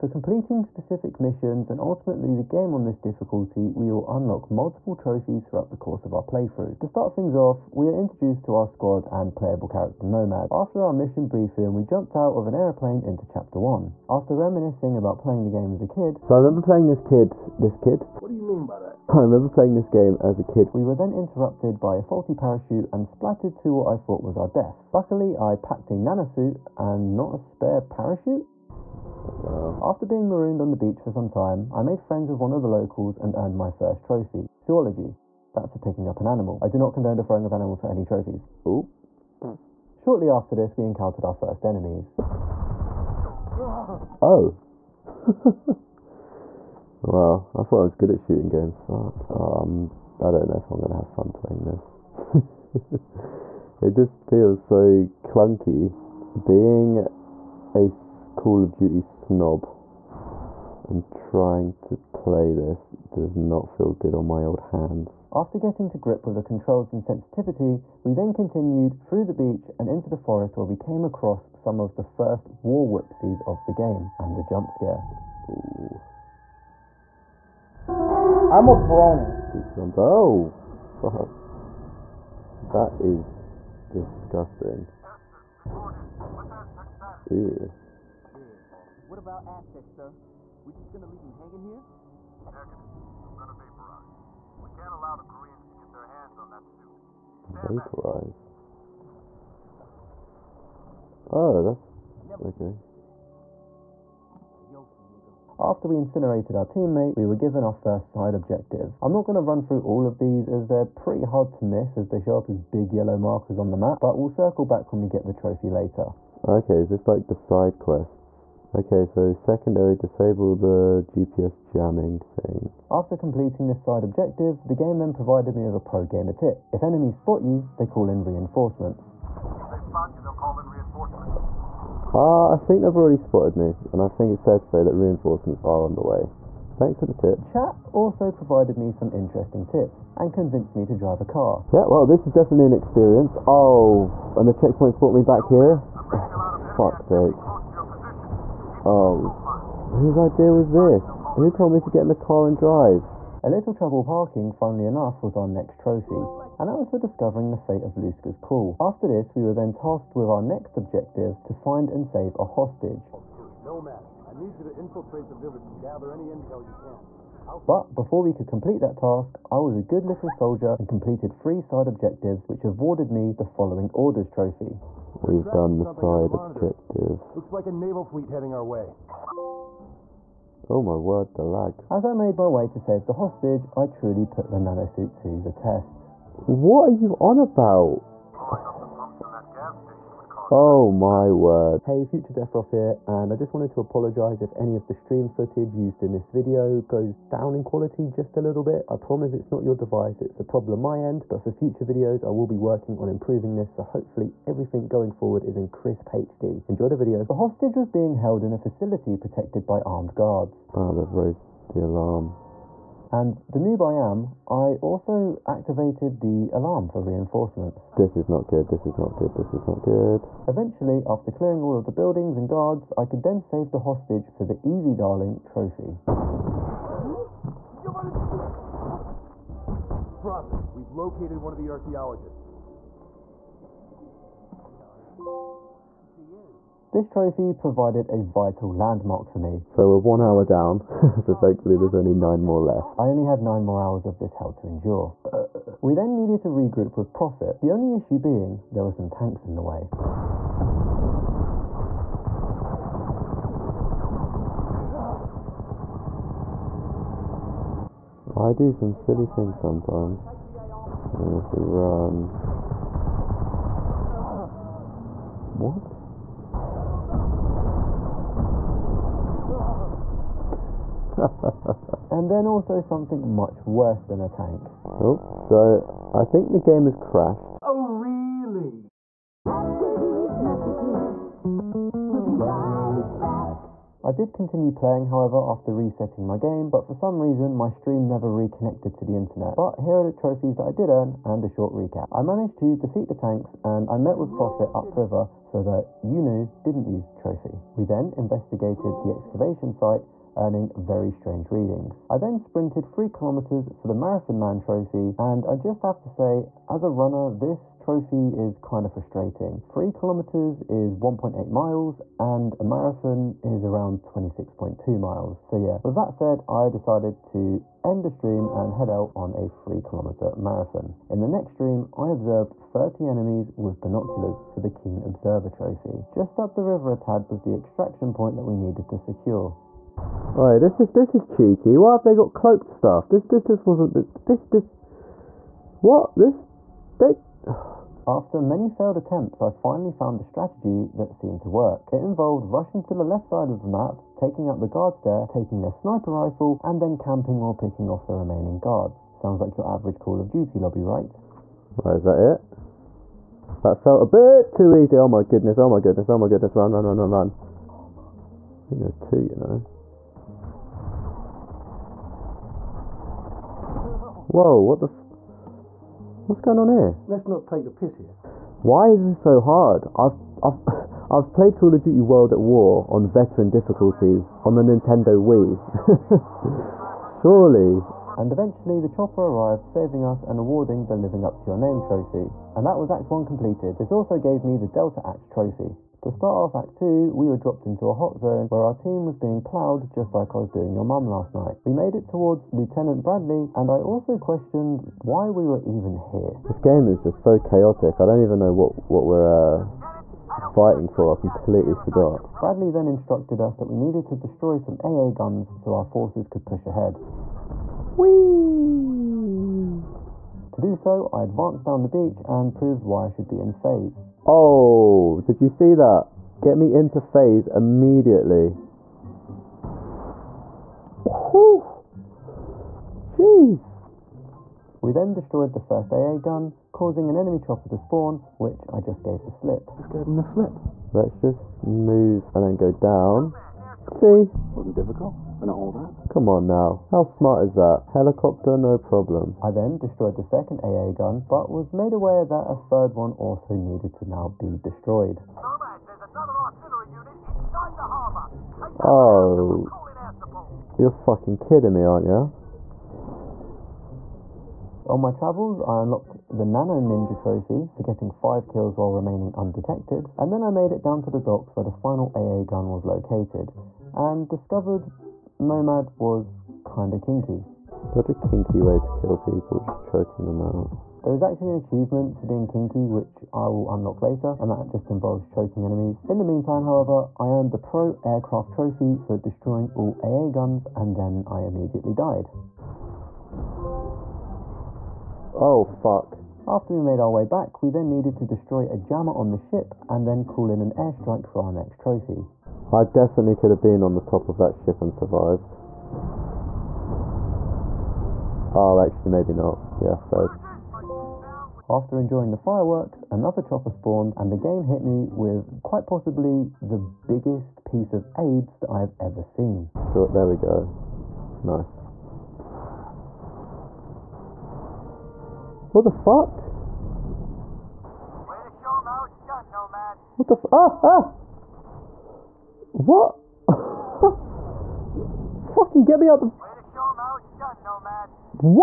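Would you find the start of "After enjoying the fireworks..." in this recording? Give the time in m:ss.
8:21.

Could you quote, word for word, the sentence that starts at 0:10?
After our mission briefing, we jumped out of an aeroplane into chapter 1.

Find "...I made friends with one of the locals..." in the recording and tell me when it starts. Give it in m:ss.
0:31.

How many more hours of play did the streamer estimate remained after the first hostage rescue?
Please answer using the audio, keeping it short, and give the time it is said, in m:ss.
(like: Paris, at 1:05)
9, at 4:03.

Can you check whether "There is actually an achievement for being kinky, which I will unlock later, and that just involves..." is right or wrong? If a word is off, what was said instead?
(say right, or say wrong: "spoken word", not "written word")
right.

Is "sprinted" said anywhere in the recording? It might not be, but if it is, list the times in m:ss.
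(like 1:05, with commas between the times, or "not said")
5:02.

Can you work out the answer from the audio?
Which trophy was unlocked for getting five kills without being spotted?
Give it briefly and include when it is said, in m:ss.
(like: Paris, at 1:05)
Nano Ninja, at 7:36.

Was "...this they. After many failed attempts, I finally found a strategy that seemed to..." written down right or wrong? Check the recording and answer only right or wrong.
right.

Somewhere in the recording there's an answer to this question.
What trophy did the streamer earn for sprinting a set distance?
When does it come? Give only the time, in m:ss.
5:03.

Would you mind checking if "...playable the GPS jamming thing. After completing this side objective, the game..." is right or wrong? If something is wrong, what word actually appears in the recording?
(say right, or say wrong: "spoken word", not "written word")
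wrong: "disable", not "playable".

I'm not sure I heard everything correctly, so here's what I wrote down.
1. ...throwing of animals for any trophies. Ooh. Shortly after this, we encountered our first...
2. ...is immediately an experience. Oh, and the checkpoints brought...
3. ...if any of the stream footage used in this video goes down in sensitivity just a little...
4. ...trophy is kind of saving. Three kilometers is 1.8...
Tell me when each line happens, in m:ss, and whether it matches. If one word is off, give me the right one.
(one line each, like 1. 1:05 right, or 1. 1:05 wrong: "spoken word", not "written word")
1. 0:37 right
2. 2:22 wrong: "definitely", not "immediately"
3. 3:14 wrong: "quality", not "sensitivity"
4. 5:07 wrong: "frustrating", not "saving".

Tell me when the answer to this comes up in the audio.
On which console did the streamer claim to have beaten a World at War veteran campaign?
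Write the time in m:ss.
6:14.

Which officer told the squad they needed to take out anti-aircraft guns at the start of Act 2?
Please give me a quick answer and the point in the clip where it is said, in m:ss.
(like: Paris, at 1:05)
Lieutenant Bradley, at 6:32.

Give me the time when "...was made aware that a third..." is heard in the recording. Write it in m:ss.
7:21.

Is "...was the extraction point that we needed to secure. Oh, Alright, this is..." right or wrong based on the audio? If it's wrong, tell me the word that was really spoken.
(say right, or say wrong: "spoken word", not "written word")
right.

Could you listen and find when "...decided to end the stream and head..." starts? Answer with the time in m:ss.
5:16.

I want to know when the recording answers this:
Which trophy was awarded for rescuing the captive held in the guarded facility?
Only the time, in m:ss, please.
3:44.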